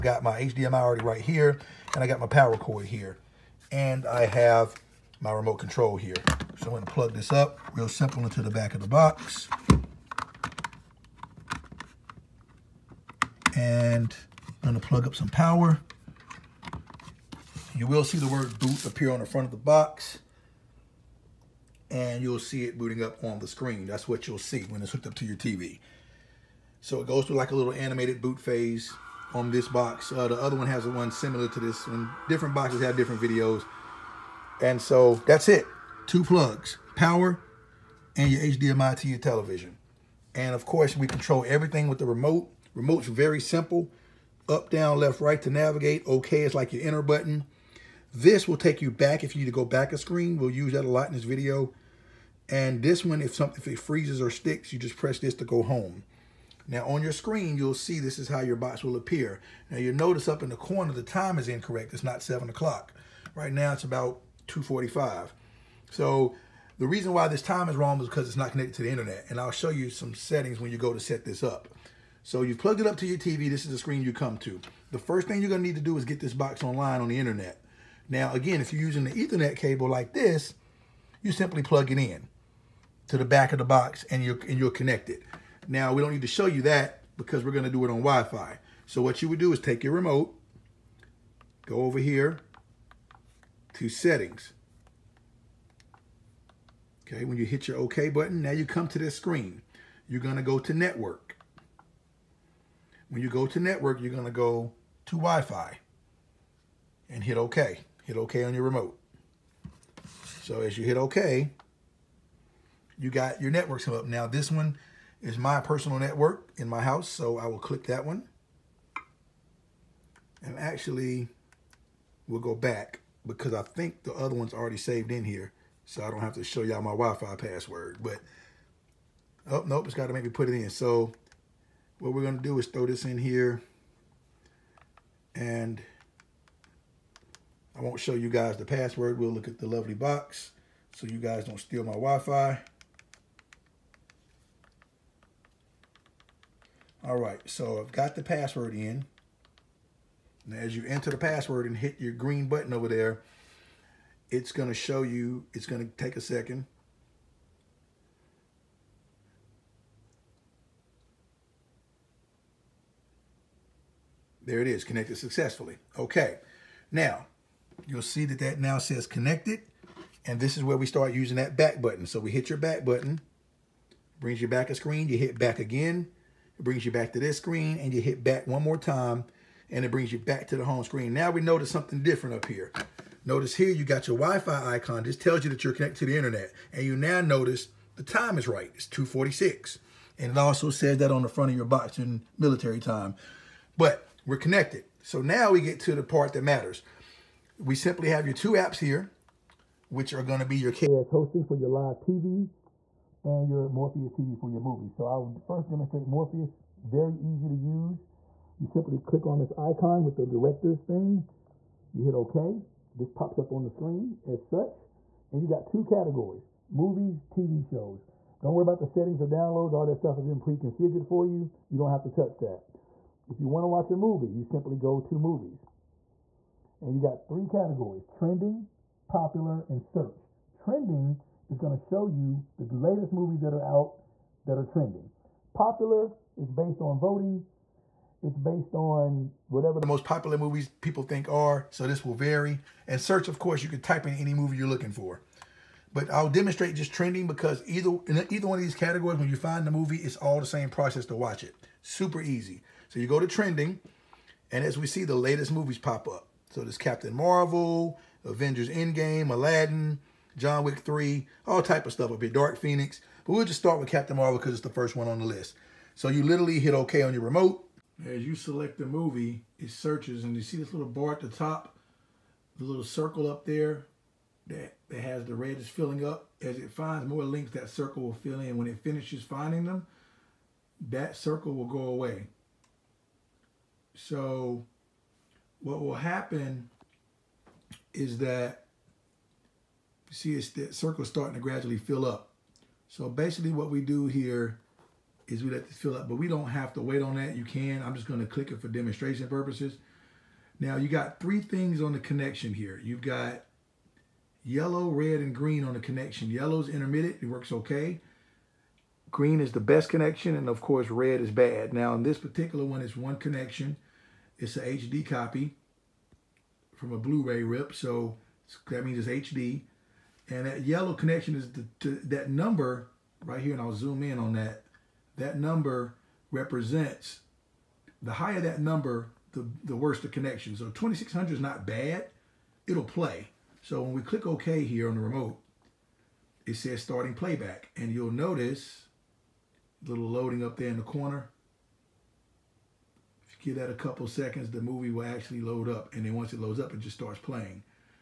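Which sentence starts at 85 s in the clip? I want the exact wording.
Now, we don't need to show you that because we're going to do it on Wi-Fi.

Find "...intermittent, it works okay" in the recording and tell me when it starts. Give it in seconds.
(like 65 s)
306 s.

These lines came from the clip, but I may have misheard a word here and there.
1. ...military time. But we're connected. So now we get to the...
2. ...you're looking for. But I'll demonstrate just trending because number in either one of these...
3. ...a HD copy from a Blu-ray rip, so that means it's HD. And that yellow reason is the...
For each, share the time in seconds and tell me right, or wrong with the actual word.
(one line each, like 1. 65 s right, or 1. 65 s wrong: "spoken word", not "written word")
1. 192 s right
2. 244 s wrong: "either", not "number"
3. 314 s wrong: "connection", not "reason".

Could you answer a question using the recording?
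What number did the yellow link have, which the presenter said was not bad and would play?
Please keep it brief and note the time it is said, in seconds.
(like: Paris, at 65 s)
2600, at 330 s.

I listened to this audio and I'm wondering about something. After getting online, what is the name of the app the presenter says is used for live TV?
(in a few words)
KS hosting.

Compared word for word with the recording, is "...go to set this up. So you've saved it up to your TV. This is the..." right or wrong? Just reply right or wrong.
wrong.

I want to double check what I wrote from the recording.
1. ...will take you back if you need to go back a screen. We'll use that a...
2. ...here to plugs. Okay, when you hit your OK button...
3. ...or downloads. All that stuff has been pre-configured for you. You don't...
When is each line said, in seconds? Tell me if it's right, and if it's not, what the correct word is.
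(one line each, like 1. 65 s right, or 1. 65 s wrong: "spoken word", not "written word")
1. 48 s right
2. 91 s wrong: "settings", not "plugs"
3. 219 s right.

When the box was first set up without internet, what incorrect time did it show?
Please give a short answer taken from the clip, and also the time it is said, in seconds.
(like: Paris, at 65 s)
7 o'clock, at 62 s.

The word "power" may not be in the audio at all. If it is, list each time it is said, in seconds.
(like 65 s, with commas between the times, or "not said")
2 s, 15 s, 36 s.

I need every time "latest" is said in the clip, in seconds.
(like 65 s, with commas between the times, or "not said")
232 s, 255 s.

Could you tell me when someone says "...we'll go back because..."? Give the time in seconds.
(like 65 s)
122 s.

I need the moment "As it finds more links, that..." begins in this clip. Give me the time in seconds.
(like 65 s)
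276 s.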